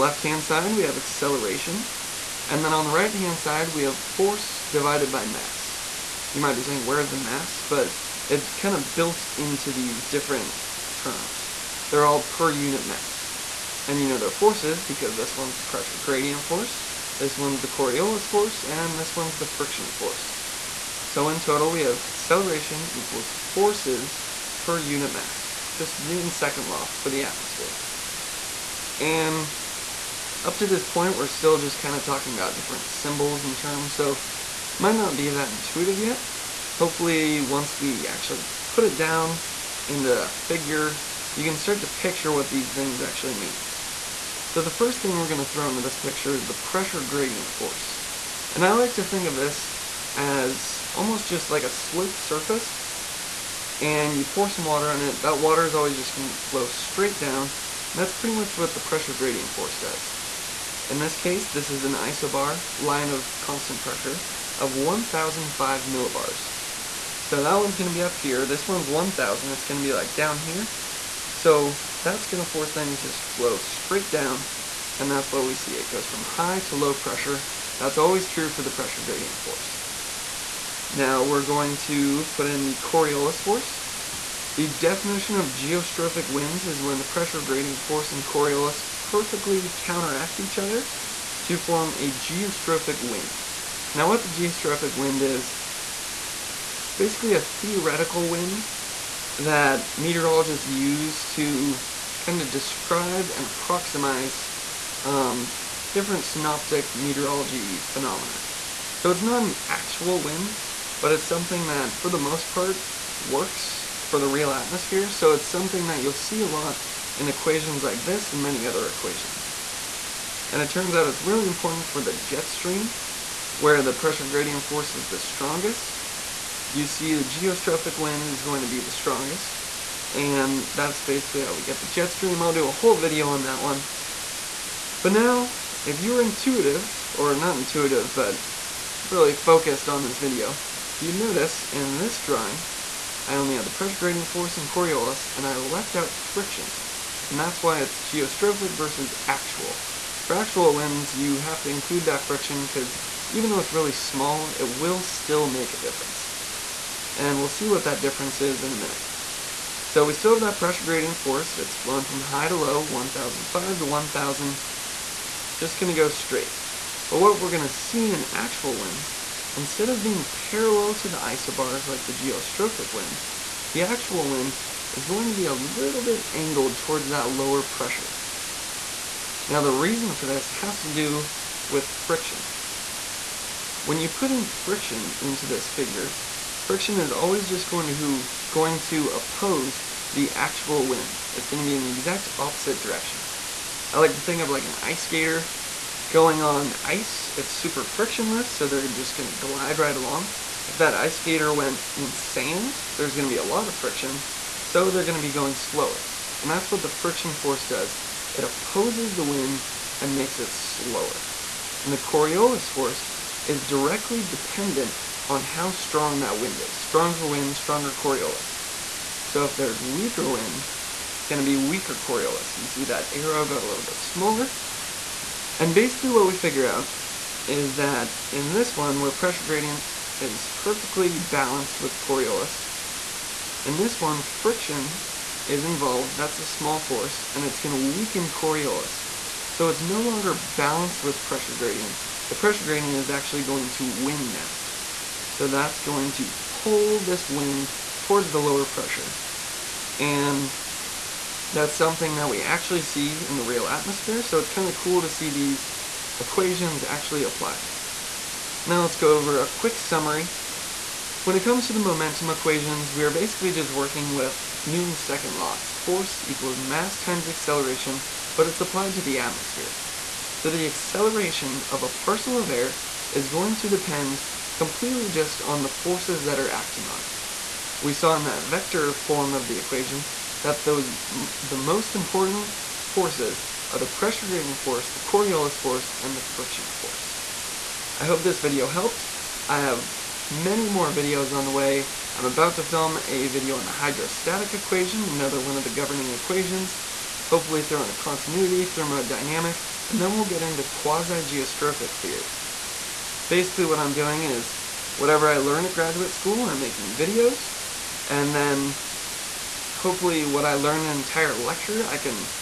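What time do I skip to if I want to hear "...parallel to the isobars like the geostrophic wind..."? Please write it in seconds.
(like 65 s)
170 s.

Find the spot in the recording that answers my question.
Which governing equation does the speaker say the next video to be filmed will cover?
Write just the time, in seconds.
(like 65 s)
293 s.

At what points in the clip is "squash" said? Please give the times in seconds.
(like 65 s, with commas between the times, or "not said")
not said.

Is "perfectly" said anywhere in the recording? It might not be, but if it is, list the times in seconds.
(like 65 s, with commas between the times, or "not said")
88 s, 230 s.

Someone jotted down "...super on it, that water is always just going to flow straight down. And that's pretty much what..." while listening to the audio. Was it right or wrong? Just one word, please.
wrong.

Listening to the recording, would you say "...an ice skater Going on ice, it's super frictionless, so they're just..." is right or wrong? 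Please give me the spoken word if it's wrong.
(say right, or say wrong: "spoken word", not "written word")
right.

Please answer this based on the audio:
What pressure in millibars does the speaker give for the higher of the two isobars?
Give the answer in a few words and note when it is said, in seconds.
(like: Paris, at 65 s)
1,005, at 64 s.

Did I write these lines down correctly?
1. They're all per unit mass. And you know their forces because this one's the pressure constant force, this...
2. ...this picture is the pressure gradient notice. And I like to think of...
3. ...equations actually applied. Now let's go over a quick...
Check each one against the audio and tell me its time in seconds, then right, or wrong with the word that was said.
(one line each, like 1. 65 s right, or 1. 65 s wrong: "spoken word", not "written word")
1. 11 s wrong: "gradient", not "constant"
2. 45 s wrong: "force", not "notice"
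3. 256 s right.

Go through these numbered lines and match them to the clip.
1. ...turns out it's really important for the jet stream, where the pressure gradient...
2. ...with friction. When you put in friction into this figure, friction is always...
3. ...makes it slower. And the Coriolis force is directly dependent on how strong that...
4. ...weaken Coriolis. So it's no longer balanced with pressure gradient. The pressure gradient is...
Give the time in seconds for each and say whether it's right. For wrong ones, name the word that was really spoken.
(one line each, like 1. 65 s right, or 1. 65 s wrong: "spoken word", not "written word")
1. 120 s right
2. 181 s right
3. 210 s right
4. 237 s right.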